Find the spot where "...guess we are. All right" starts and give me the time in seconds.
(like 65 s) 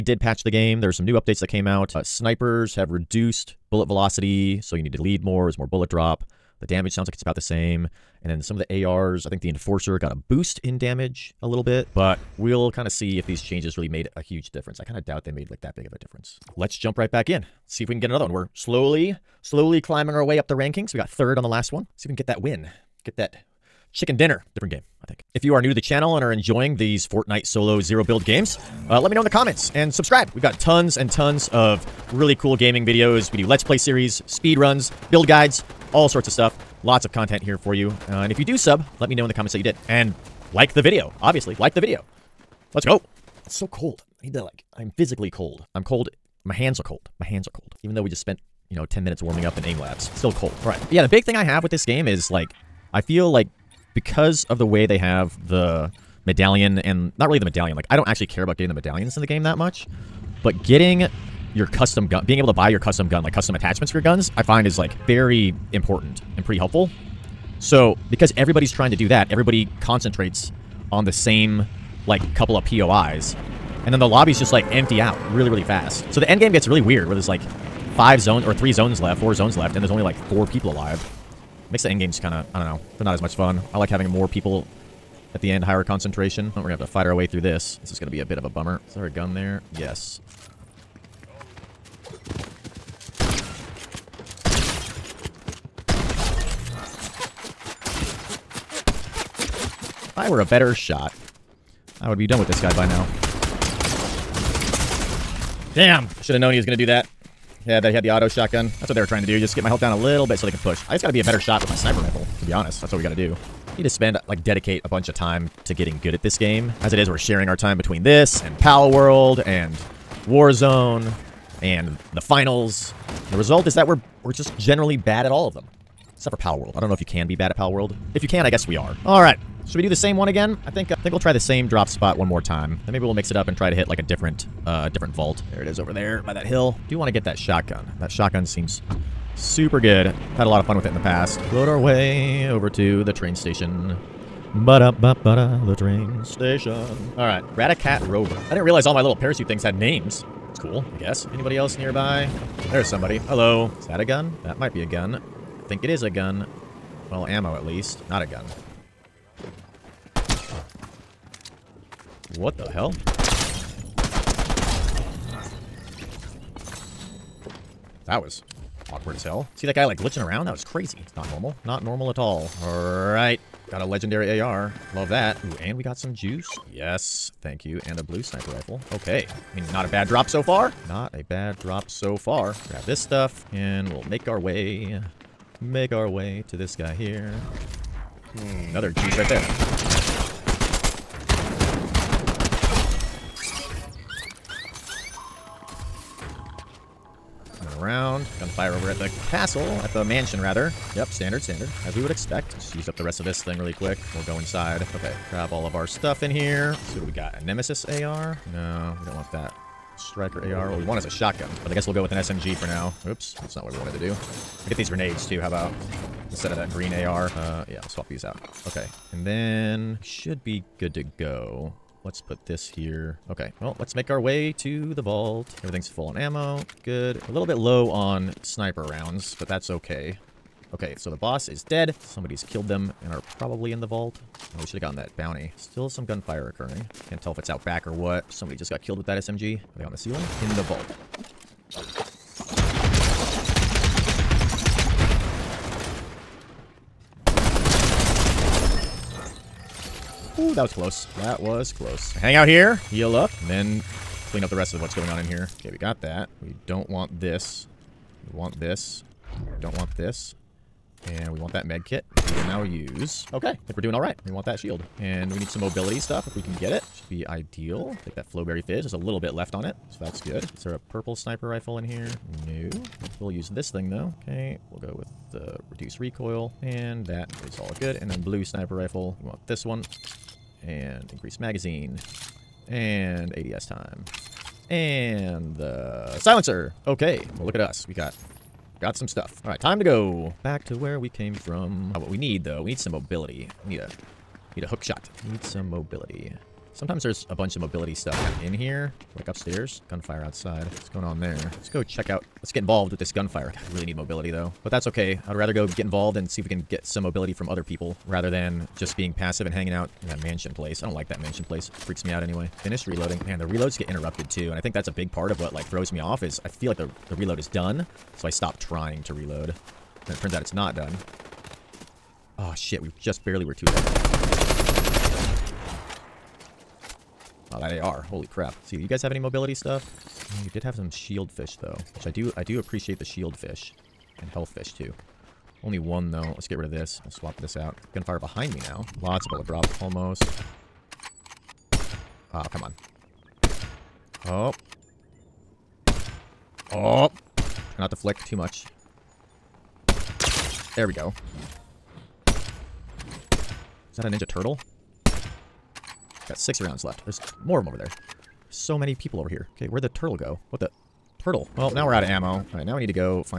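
128 s.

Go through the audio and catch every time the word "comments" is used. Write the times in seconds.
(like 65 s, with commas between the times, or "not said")
29 s, 39 s.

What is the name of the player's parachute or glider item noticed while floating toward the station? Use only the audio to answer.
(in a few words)
Ratacat Rover.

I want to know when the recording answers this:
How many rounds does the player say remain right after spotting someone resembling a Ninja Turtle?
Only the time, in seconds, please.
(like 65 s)
356 s.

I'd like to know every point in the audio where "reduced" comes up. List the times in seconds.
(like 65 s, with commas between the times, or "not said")
2 s, 275 s.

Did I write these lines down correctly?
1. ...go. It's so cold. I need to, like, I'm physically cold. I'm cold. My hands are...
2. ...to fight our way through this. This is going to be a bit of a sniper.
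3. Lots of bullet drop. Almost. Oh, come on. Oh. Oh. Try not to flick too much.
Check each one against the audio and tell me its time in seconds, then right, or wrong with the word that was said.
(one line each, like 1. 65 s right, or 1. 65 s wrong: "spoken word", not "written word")
1. 42 s right
2. 86 s wrong: "bummer", not "sniper"
3. 339 s right.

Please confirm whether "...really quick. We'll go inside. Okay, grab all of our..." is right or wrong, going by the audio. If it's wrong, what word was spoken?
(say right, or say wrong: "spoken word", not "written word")
right.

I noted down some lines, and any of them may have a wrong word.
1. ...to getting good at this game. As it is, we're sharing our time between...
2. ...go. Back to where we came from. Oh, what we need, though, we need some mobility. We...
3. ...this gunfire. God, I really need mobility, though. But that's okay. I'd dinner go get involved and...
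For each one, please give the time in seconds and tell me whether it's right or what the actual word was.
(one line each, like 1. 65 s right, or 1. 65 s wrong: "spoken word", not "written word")
1. 115 s right
2. 289 s right
3. 302 s wrong: "rather", not "dinner".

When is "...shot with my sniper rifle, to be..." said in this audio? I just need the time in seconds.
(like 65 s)
111 s.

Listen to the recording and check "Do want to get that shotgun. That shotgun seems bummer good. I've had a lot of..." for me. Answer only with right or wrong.
wrong.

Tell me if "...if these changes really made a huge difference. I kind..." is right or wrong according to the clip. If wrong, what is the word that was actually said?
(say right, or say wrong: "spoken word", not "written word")
right.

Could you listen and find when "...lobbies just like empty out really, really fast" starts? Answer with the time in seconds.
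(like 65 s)
74 s.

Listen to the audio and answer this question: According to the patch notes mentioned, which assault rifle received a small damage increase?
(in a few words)
Enforcer.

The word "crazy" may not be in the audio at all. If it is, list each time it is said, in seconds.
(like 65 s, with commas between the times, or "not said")
170 s.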